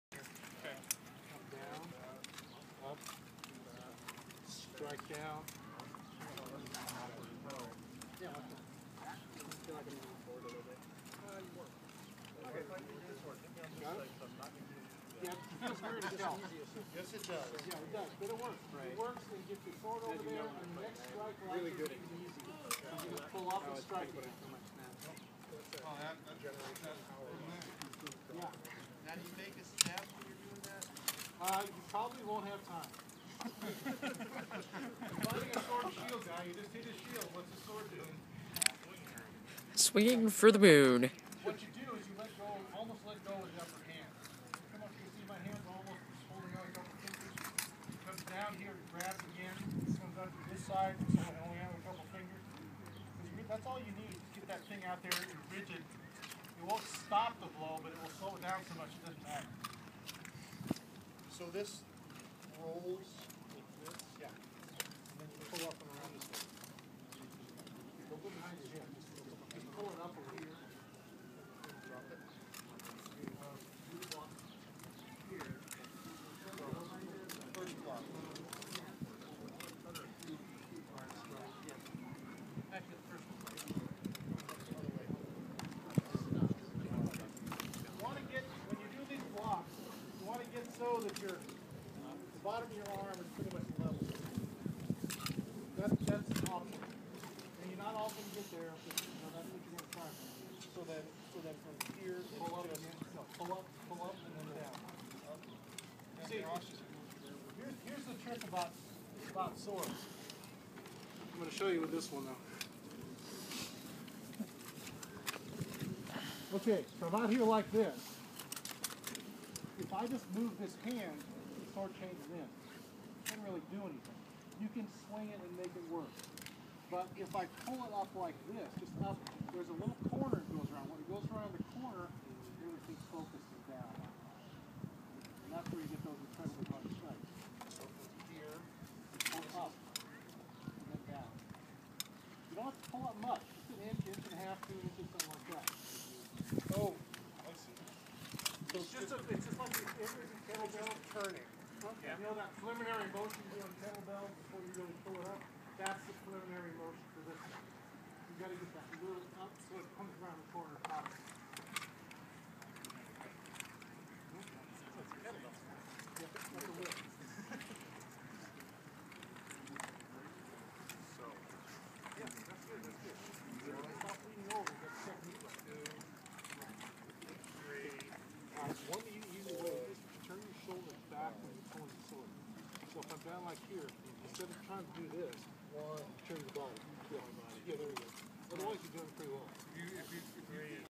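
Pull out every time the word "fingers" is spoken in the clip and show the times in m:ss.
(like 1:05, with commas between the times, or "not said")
0:47, 0:52.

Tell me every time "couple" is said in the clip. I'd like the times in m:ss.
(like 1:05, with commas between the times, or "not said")
0:46, 0:51.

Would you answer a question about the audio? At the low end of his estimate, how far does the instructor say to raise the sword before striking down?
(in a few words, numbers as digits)
an inch.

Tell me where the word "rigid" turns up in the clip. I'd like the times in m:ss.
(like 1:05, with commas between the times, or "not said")
0:55.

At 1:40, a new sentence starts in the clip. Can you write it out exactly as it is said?
So then, so then from here, it's pull up, just, no, pull up, pull up, and then down.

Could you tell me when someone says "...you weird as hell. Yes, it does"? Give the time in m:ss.
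0:15.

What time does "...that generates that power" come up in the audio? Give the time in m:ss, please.
0:26.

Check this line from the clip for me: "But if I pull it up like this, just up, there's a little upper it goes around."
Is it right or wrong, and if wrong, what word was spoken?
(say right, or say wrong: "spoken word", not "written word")
wrong: "corner", not "upper".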